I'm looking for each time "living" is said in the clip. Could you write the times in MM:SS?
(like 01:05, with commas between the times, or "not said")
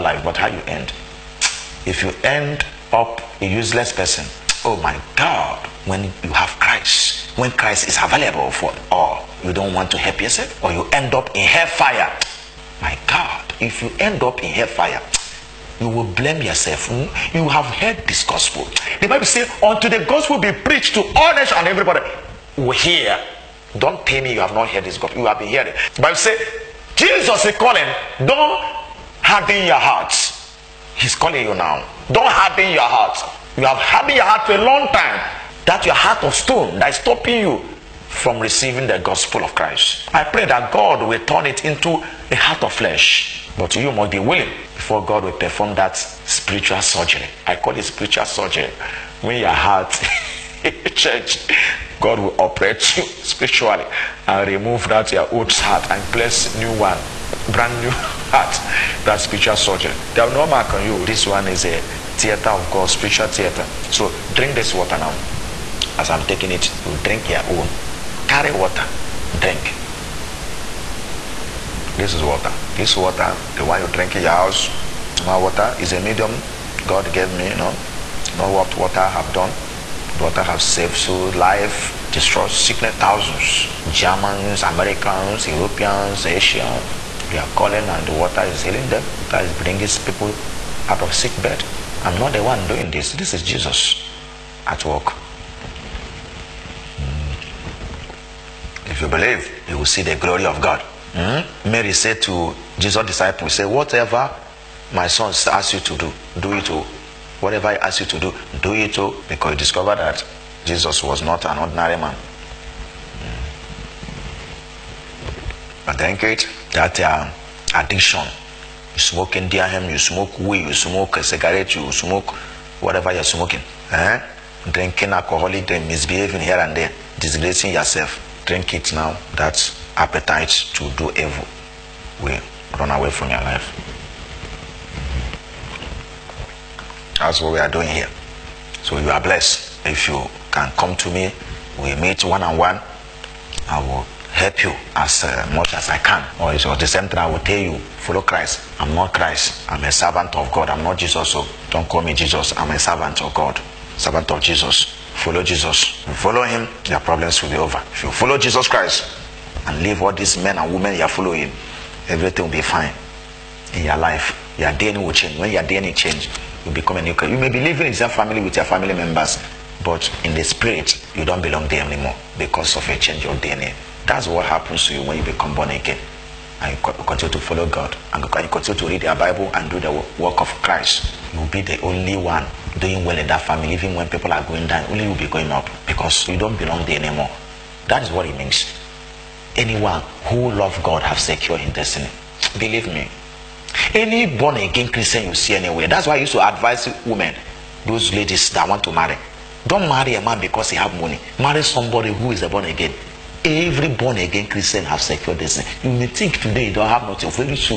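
02:47.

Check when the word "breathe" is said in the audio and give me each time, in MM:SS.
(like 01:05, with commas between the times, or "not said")
not said.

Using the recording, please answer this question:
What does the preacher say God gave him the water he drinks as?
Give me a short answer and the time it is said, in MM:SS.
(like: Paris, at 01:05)
a medium, at 01:16.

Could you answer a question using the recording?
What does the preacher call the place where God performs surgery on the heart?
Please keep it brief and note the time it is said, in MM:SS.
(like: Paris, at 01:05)
spiritual theater, at 01:02.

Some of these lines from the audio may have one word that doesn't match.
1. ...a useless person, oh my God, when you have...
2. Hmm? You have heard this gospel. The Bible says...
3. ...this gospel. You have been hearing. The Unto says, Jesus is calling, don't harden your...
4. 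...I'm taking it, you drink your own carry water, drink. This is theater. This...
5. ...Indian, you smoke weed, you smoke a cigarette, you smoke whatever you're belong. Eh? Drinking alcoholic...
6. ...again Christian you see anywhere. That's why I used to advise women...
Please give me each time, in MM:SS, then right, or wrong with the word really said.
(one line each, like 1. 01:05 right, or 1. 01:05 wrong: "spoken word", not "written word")
1. 00:03 right
2. 00:16 right
3. 00:24 wrong: "Bible", not "Unto"
4. 01:06 wrong: "water", not "theater"
5. 01:59 wrong: "smoking", not "belong"
6. 03:14 right.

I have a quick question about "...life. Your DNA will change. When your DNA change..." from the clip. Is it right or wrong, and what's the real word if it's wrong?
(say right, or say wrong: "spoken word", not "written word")
right.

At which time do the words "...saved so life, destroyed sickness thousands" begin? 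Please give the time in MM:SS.
01:20.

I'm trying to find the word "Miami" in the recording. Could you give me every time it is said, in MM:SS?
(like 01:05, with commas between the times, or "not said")
not said.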